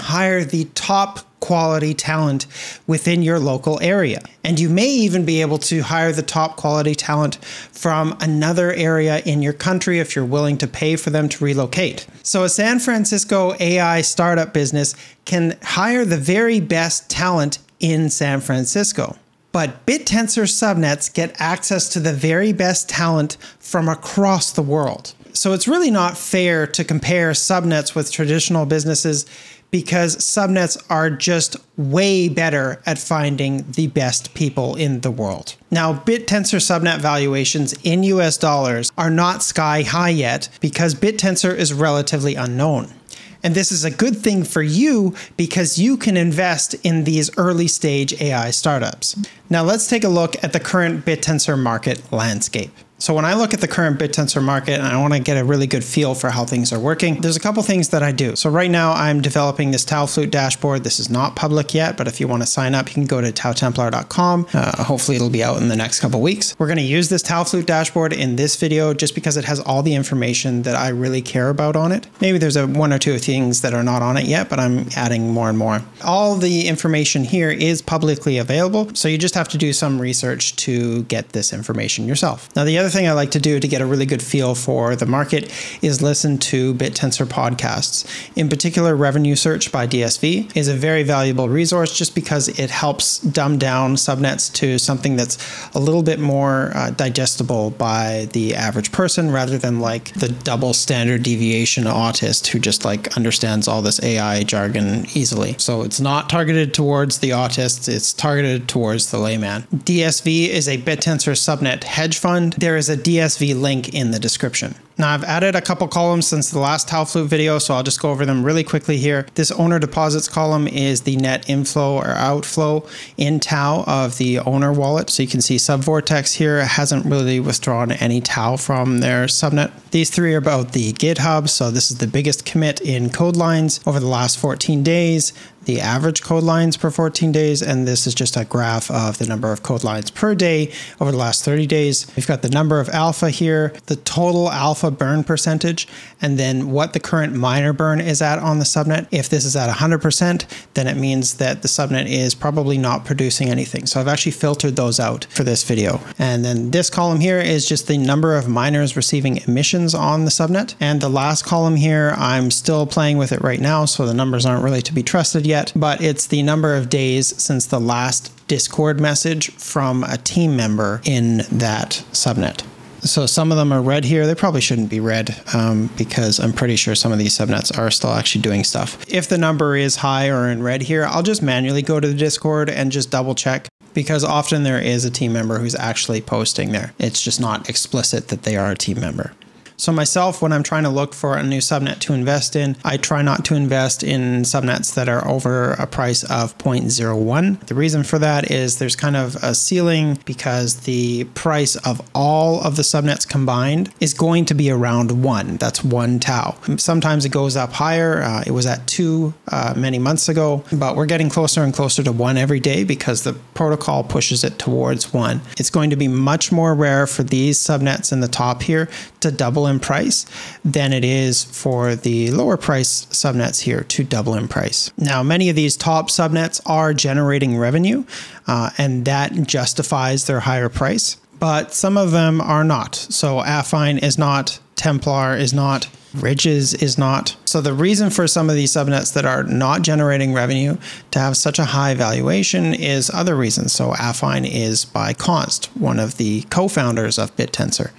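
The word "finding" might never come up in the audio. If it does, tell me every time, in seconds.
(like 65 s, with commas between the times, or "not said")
32 s.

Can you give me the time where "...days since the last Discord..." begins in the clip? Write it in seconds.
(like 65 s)
166 s.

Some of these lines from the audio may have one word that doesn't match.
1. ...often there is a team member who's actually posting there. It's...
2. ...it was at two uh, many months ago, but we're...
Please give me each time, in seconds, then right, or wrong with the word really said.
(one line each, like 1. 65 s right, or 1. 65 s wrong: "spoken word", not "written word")
1. 184 s right
2. 208 s right.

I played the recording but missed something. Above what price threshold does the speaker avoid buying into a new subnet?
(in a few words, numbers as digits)
0.01.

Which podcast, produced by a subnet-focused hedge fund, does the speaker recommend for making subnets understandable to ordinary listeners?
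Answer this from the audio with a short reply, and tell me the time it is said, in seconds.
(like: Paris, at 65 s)
Revenue Search, at 88 s.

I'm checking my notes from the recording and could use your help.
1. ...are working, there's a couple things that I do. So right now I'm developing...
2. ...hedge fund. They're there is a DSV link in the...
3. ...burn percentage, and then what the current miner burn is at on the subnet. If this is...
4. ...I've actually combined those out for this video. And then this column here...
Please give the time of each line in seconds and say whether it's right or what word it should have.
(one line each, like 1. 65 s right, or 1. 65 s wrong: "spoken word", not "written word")
1. 56 s right
2. 111 s right
3. 144 s right
4. 153 s wrong: "filtered", not "combined".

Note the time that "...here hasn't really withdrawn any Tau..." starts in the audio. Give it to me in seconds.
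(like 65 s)
126 s.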